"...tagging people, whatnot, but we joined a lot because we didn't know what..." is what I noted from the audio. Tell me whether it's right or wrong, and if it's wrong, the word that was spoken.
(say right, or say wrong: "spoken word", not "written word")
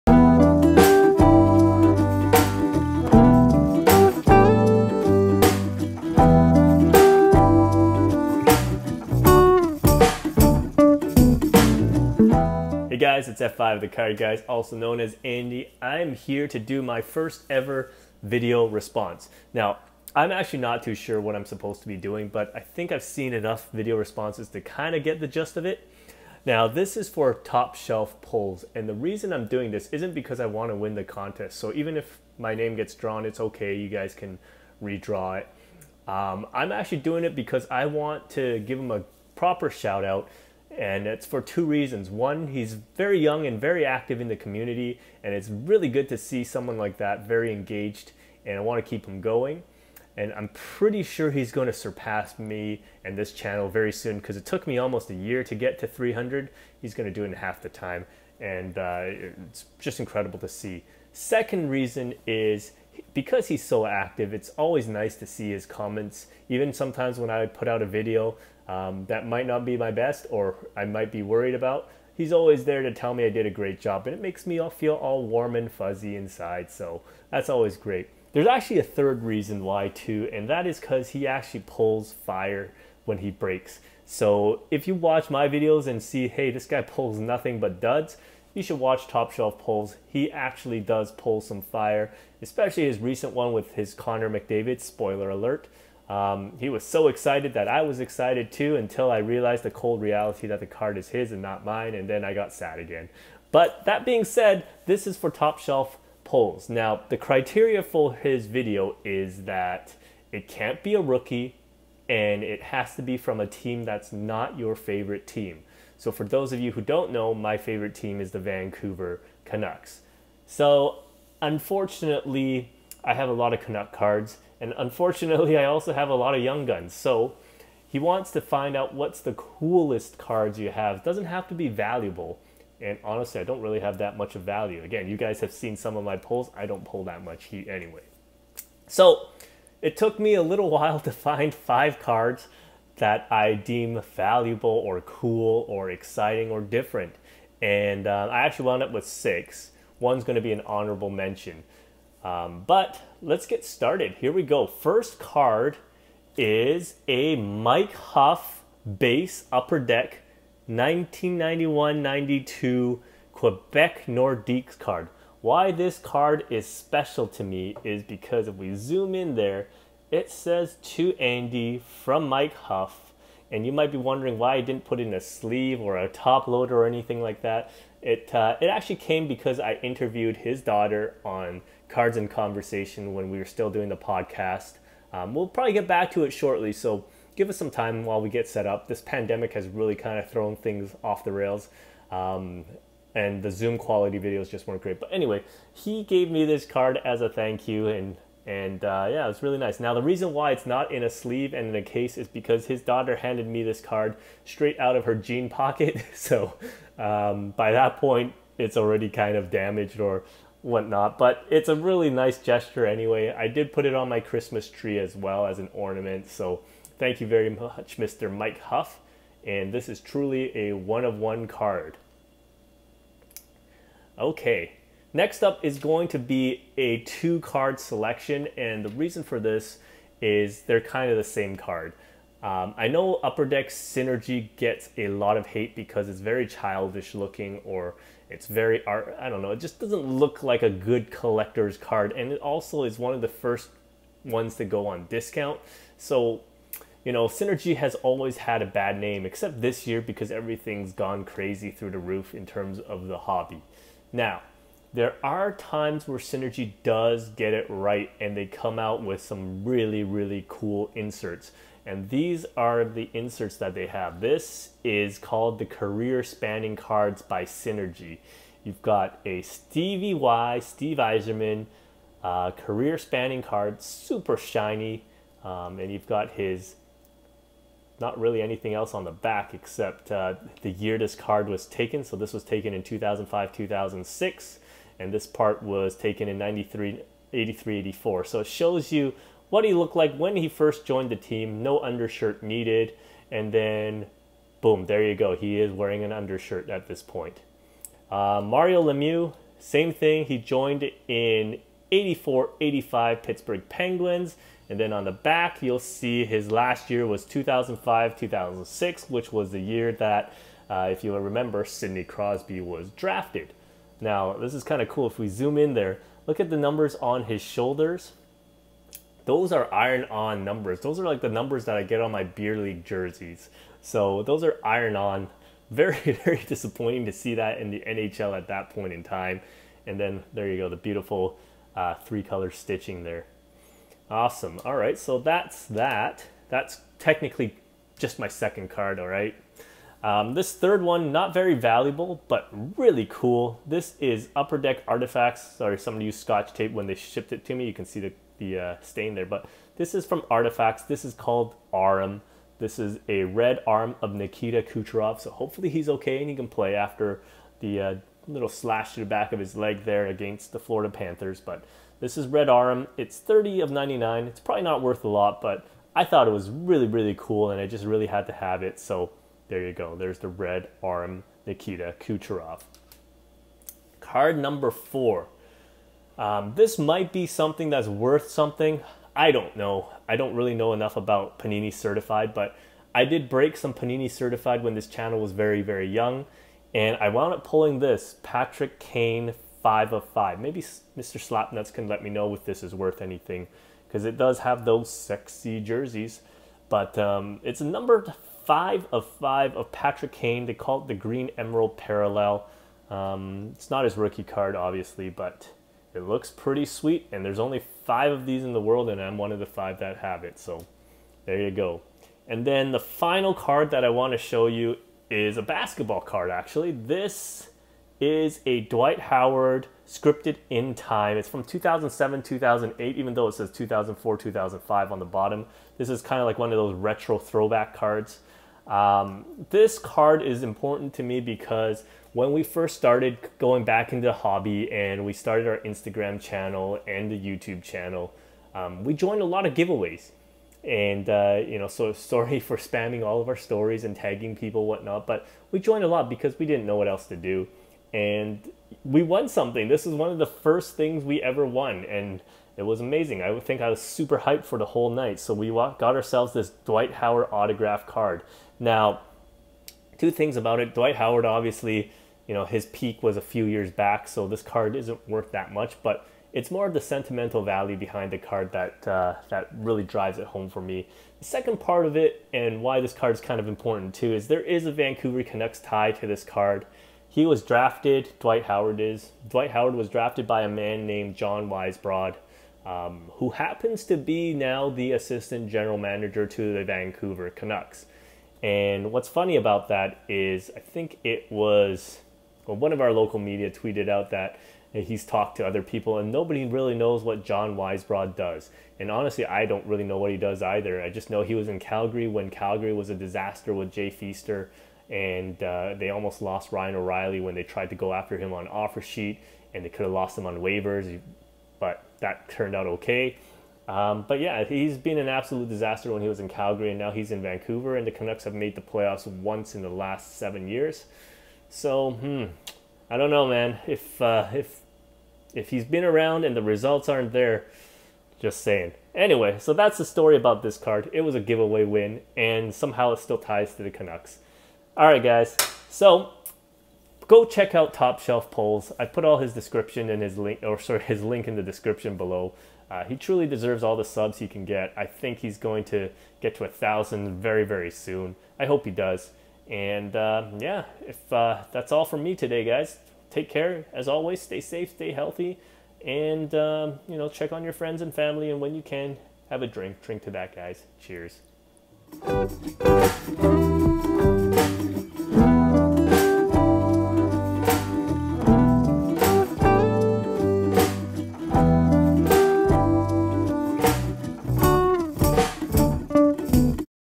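right.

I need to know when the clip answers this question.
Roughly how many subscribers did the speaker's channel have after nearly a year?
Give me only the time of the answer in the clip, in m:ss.
0:55.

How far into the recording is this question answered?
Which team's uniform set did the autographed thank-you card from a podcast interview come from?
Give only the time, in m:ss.
2:43.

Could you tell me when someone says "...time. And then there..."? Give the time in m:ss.
5:29.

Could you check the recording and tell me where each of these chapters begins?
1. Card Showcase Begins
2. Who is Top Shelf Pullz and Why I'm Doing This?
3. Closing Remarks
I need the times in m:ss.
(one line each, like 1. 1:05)
1. 1:47
2. 0:25
3. 8:57.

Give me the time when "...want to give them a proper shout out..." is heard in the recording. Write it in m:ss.
0:37.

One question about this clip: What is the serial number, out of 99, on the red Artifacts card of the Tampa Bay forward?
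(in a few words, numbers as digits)
30.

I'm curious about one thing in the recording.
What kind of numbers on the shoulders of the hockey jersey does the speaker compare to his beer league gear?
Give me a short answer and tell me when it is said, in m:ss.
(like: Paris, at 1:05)
Iron-on numbers, at 5:19.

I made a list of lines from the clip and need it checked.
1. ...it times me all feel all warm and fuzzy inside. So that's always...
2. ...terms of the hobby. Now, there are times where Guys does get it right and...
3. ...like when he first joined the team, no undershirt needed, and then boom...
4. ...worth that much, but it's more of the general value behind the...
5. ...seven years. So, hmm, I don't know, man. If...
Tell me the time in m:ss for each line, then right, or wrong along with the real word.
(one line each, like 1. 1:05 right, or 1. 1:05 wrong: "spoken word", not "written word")
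1. 1:14 wrong: "makes", not "times"
2. 4:12 wrong: "Synergy", not "Guys"
3. 4:49 right
4. 7:45 wrong: "sentimental", not "general"
5. 8:40 right.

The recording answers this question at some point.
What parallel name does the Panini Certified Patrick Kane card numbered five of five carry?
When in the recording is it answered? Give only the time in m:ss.
6:40.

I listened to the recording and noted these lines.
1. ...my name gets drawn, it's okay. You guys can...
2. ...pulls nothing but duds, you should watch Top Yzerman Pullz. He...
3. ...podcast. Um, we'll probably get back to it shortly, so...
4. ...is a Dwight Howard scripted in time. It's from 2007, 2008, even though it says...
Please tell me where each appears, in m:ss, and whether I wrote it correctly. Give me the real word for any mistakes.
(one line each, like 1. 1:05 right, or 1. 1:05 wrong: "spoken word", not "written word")
1. 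0:32 right
2. 1:26 wrong: "Shelf", not "Yzerman"
3. 3:03 right
4. 6:57 right.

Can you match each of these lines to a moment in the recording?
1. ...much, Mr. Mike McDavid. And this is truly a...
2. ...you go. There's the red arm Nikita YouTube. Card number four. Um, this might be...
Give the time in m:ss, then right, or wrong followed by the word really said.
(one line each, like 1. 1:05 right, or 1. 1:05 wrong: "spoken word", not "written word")
1. 3:37 wrong: "Hough", not "McDavid"
2. 6:09 wrong: "Kucherov", not "YouTube".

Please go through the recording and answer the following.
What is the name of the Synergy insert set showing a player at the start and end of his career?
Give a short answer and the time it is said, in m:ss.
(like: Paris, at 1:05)
Career Spanning Cards, at 4:25.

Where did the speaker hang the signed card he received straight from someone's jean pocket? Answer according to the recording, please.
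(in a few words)
Christmas tree.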